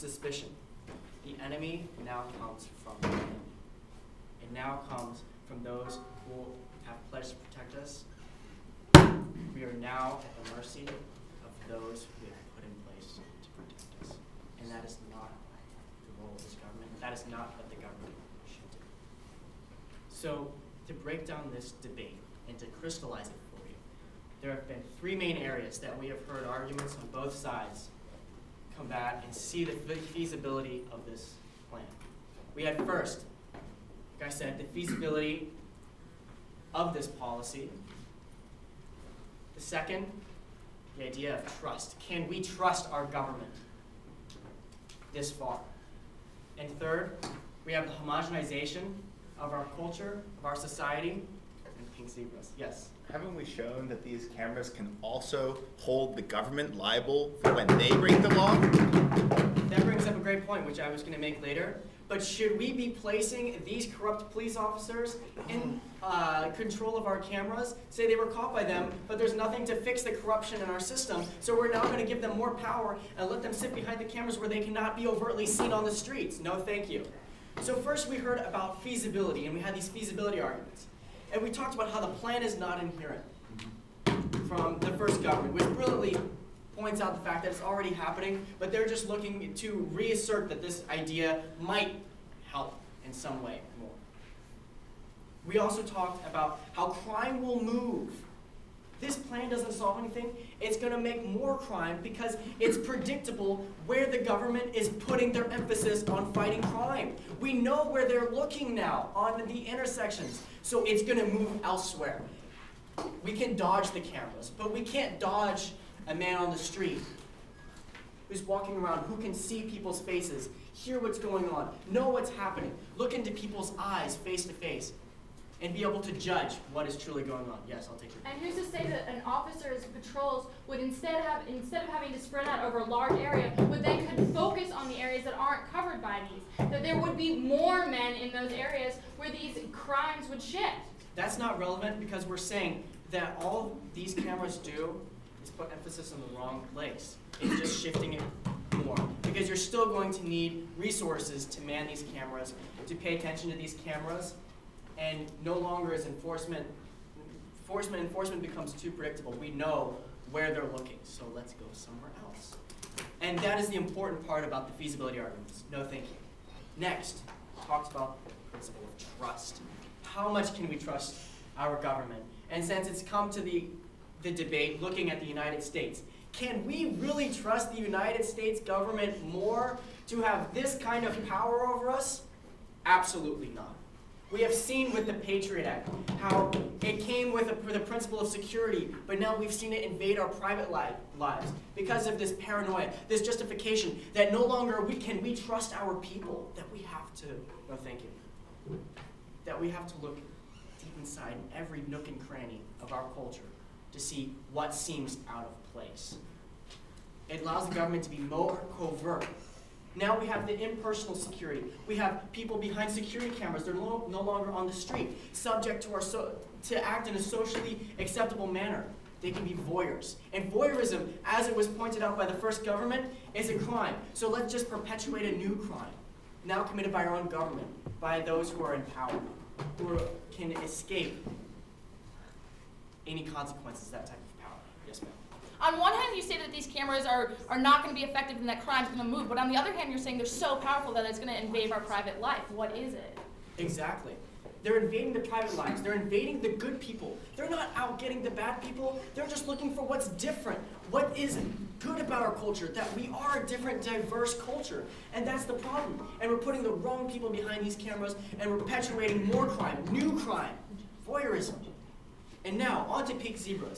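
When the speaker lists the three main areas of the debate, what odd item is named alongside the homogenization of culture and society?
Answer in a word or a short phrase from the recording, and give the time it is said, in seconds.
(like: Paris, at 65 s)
pink zebras, at 51 s.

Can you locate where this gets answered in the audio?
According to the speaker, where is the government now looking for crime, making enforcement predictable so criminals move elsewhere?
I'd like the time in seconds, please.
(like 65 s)
109 s.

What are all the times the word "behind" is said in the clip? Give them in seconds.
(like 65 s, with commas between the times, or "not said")
73 s, 212 s, 257 s.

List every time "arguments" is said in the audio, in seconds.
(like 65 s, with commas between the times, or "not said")
26 s, 80 s, 165 s.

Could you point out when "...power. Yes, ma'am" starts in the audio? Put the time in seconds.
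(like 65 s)
234 s.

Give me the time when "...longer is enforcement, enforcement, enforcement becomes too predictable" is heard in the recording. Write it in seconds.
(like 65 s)
155 s.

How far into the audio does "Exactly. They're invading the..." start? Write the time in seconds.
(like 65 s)
243 s.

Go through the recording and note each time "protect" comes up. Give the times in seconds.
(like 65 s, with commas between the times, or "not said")
7 s, 13 s.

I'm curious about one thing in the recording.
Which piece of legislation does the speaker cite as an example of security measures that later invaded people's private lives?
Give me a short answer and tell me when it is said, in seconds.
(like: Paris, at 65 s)
the Patriot Act, at 185 s.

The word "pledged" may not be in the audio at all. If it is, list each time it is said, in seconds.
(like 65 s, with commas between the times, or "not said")
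7 s.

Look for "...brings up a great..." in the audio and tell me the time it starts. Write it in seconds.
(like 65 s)
59 s.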